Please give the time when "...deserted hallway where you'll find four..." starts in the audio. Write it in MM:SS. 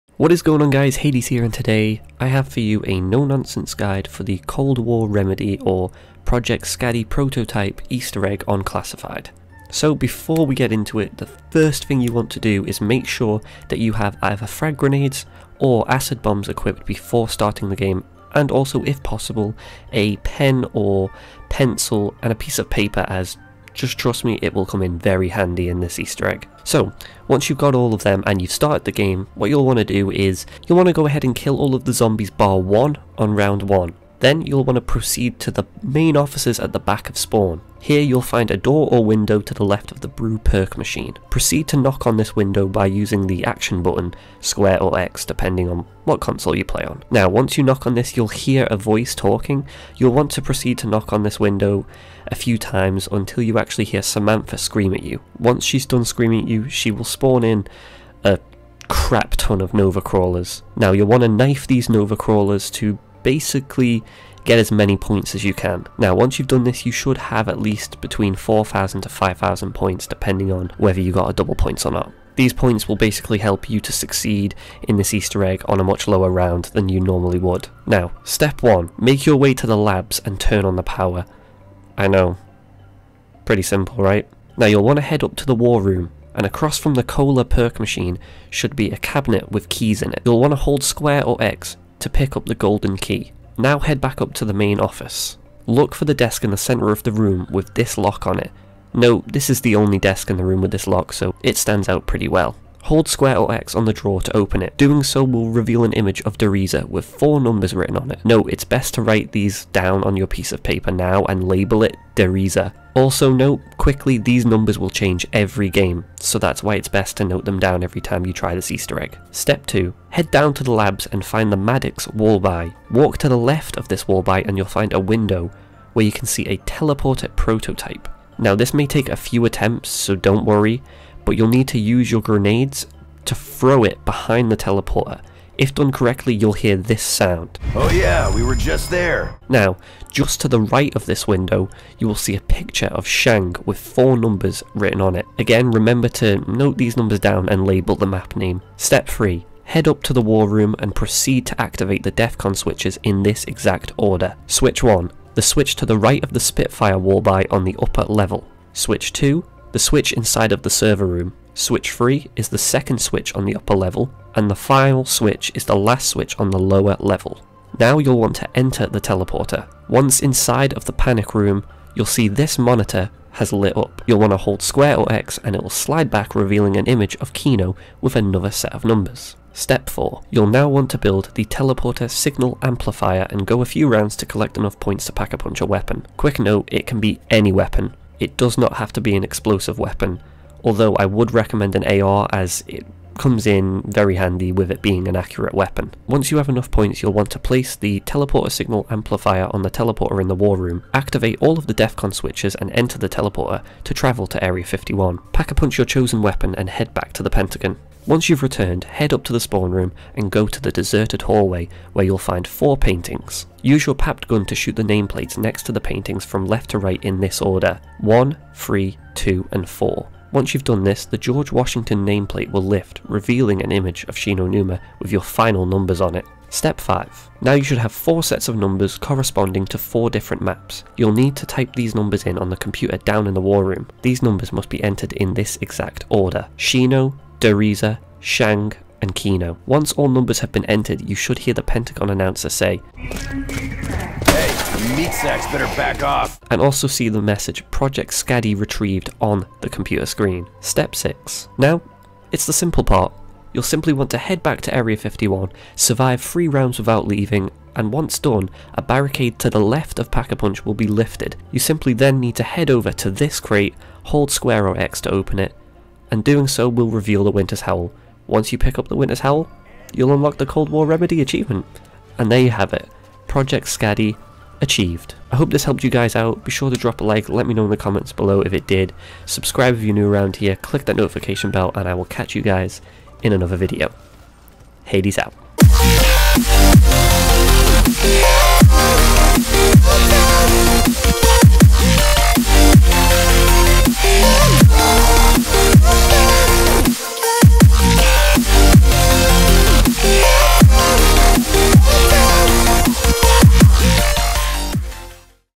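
03:30.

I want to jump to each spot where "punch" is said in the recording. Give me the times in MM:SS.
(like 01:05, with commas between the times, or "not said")
03:05, 03:25, 04:20.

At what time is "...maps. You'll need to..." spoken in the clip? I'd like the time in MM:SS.
03:50.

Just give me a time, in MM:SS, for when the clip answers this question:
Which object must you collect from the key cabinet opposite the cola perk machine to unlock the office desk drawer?
01:32.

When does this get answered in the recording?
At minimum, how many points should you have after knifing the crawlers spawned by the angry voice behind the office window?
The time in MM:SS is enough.
01:08.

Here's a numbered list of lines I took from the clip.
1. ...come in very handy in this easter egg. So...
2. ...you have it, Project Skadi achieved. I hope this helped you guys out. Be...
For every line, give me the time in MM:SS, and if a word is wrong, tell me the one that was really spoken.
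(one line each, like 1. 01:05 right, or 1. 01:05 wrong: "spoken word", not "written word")
1. 00:24 right
2. 04:32 right.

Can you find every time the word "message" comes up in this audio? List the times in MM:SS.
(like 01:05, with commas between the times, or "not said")
04:07.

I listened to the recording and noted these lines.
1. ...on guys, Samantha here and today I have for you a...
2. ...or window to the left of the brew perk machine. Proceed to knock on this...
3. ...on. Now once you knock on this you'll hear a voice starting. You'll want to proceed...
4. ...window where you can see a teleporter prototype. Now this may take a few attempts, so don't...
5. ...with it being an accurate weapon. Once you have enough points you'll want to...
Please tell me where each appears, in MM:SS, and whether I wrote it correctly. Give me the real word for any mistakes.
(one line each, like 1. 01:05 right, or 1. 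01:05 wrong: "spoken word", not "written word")
1. 00:00 wrong: "Hades", not "Samantha"
2. 00:38 right
3. 00:46 wrong: "talking", not "starting"
4. 02:04 right
5. 03:14 right.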